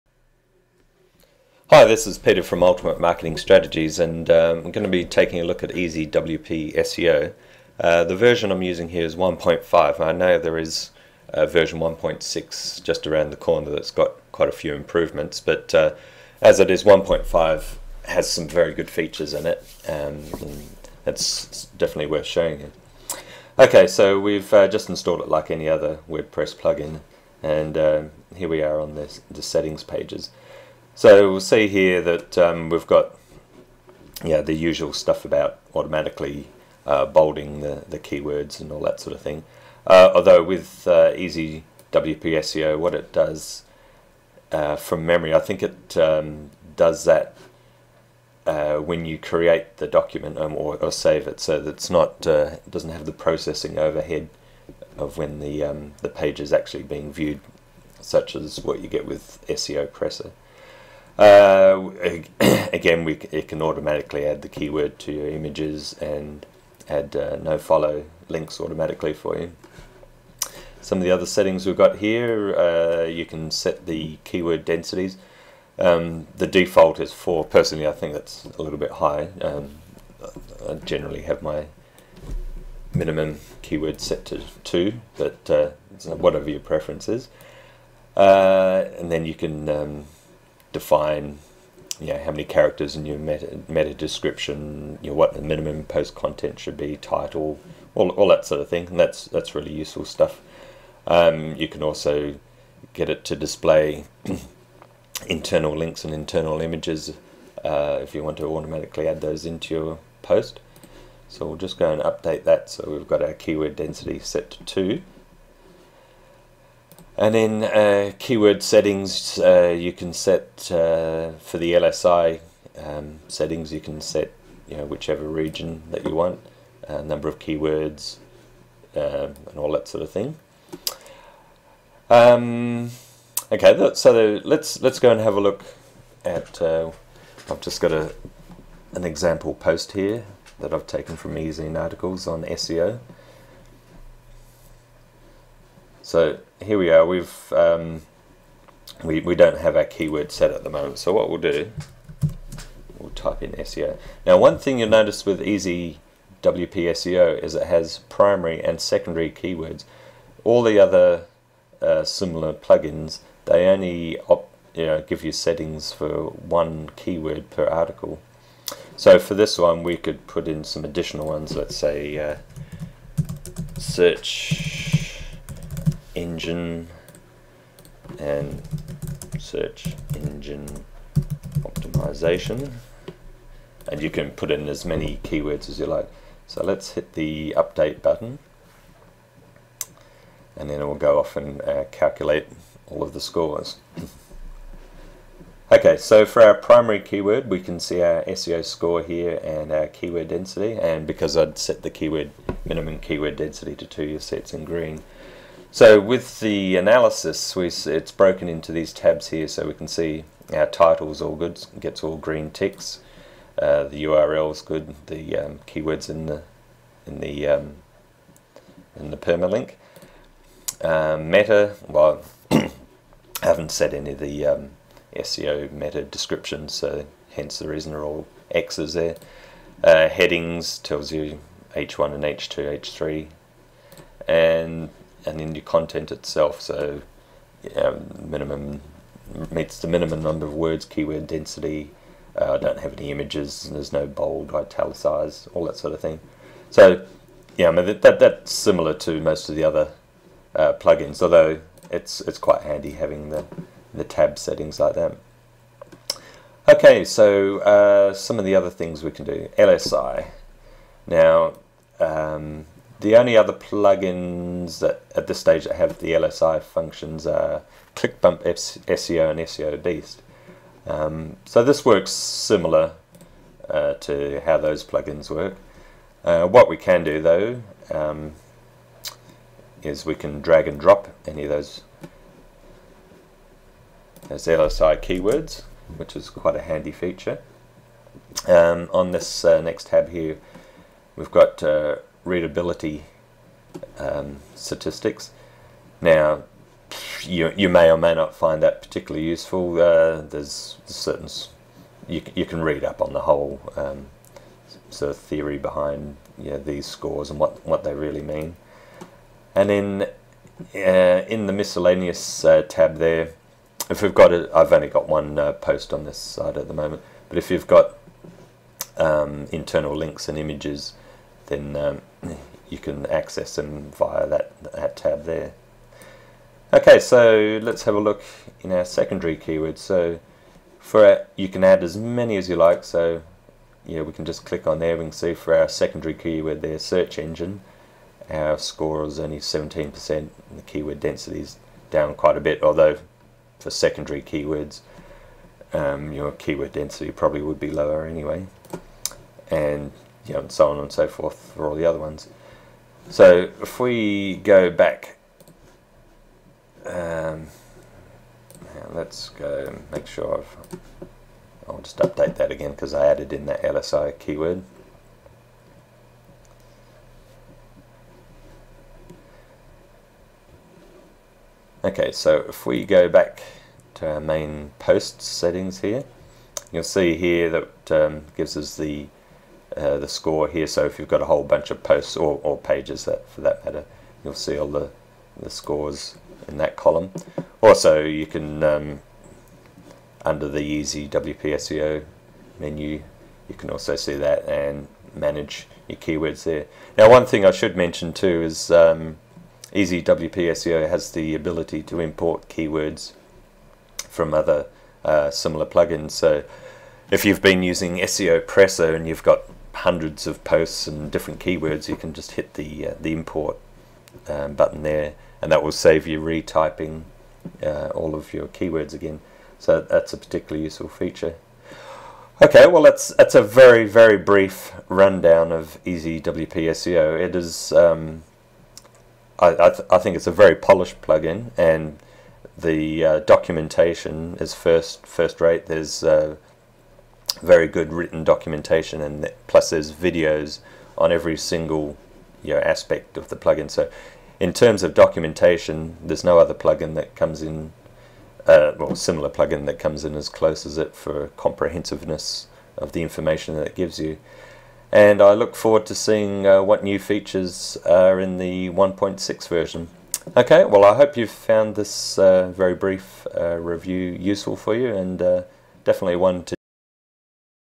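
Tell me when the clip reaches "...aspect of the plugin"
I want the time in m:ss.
7:22.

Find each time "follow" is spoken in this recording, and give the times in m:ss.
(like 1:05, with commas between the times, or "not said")
1:07.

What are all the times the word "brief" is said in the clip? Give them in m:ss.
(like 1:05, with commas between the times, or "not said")
7:04, 7:42.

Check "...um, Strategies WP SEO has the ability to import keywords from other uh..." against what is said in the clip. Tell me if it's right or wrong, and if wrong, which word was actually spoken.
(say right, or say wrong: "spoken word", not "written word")
wrong: "Easy", not "Strategies".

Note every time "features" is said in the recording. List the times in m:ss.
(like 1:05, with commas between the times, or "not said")
0:18, 4:46, 7:00, 7:36.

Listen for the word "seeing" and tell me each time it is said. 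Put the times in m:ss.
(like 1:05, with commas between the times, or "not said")
7:35.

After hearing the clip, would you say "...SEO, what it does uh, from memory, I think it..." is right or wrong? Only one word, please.
right.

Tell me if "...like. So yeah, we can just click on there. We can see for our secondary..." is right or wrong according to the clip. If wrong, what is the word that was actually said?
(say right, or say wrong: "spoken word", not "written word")
right.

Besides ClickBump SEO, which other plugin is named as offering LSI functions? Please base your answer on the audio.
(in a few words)
SEO Beast.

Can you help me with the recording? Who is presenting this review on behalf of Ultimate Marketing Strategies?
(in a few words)
Peter.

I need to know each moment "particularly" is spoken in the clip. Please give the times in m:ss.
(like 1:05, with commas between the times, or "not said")
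4:58, 7:00.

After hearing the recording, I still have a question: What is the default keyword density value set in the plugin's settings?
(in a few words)
4.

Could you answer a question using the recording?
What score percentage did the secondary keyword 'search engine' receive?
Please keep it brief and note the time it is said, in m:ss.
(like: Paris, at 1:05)
17%, at 5:39.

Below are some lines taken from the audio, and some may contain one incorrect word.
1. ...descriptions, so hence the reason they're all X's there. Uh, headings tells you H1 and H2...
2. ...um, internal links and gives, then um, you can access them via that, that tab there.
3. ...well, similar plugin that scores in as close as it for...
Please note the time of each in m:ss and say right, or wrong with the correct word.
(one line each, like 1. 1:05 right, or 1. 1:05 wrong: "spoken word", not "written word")
1. 3:46 right
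2. 5:18 wrong: "images", not "gives"
3. 7:28 wrong: "comes", not "scores".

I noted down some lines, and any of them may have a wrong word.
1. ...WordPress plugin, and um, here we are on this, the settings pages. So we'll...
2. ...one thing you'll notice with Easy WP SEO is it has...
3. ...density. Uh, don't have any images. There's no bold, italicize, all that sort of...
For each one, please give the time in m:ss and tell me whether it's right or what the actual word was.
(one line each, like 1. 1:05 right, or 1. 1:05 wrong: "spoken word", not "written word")
1. 0:26 right
2. 2:34 right
3. 4:01 right.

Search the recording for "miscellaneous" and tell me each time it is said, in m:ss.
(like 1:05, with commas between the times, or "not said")
5:11.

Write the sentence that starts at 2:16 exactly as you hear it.
Uh, I've just got a an example post here that I've taken from EzineArticles on SEO.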